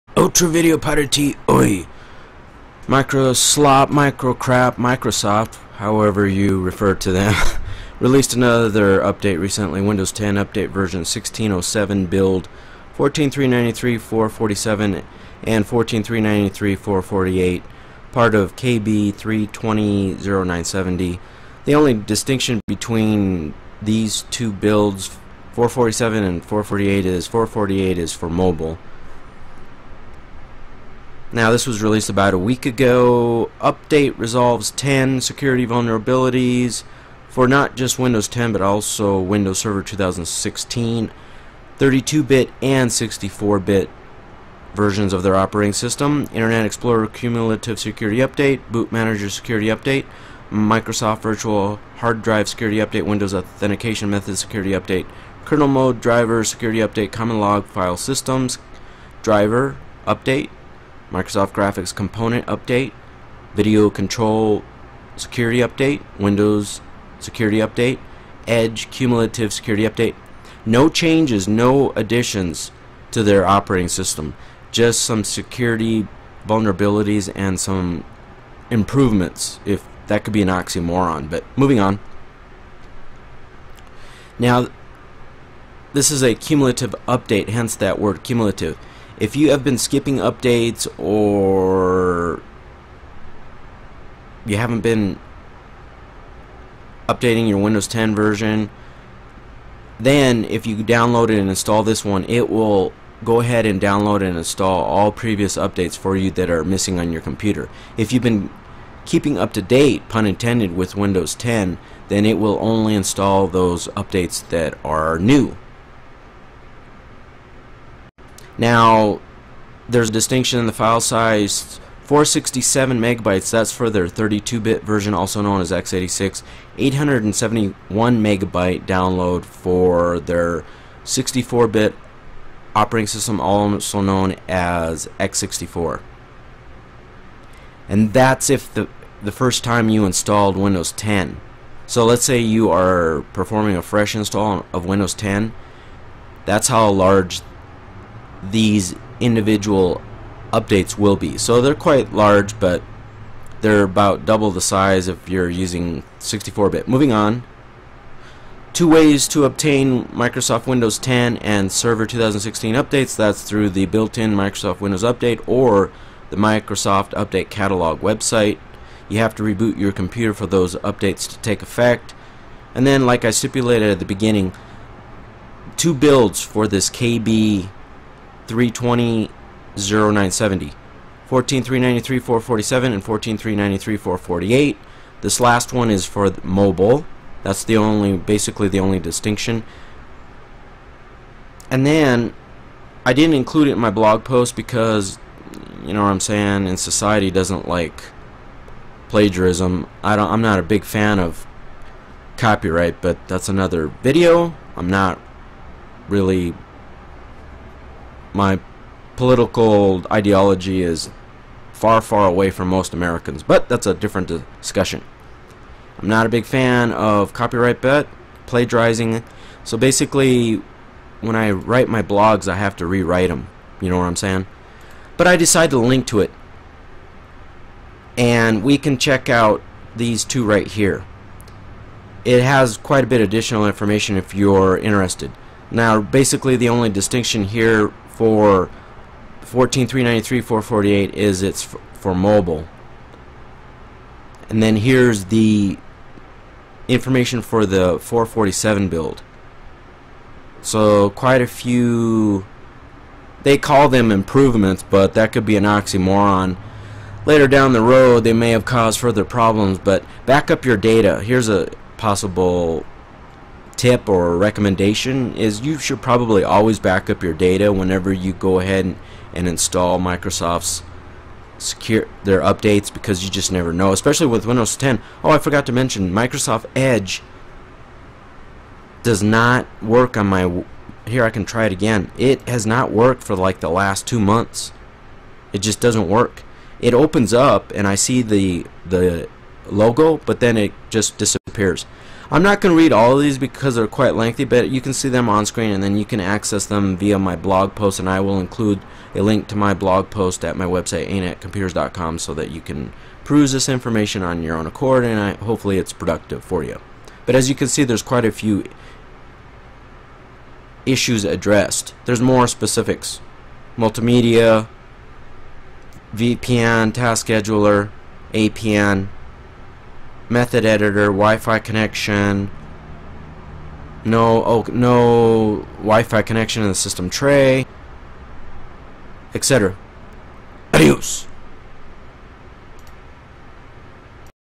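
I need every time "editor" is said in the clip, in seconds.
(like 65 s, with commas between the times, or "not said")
320 s.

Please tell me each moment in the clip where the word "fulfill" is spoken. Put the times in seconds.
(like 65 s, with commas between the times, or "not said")
not said.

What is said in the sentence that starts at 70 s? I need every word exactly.
No changes, no additions to their operating system, just some security vulnerabilities and some improvements, if that could be an oxymoron.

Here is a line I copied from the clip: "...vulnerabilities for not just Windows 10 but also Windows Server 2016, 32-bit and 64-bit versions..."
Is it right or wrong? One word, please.
right.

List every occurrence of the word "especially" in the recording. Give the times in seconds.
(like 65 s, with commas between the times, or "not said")
273 s.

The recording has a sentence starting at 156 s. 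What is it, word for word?
Moving on, two ways to obtain Microsoft Windows 10 and Server 2016 updates.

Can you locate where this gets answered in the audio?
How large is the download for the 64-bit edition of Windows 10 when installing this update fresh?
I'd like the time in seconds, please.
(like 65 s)
126 s.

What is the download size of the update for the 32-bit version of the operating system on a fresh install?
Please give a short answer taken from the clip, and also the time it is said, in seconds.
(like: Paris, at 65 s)
467 megabytes, at 122 s.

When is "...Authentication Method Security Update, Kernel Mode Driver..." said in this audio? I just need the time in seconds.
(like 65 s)
53 s.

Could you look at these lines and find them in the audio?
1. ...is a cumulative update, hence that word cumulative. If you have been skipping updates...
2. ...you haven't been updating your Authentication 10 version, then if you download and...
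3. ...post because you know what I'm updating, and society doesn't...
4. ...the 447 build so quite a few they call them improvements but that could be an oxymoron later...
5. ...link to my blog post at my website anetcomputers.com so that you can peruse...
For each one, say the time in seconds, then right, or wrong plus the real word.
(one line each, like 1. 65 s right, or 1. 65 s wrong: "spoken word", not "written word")
1. 86 s right
2. 94 s wrong: "Windows", not "Authentication"
3. 194 s wrong: "saying", not "updating"
4. 247 s right
5. 299 s right.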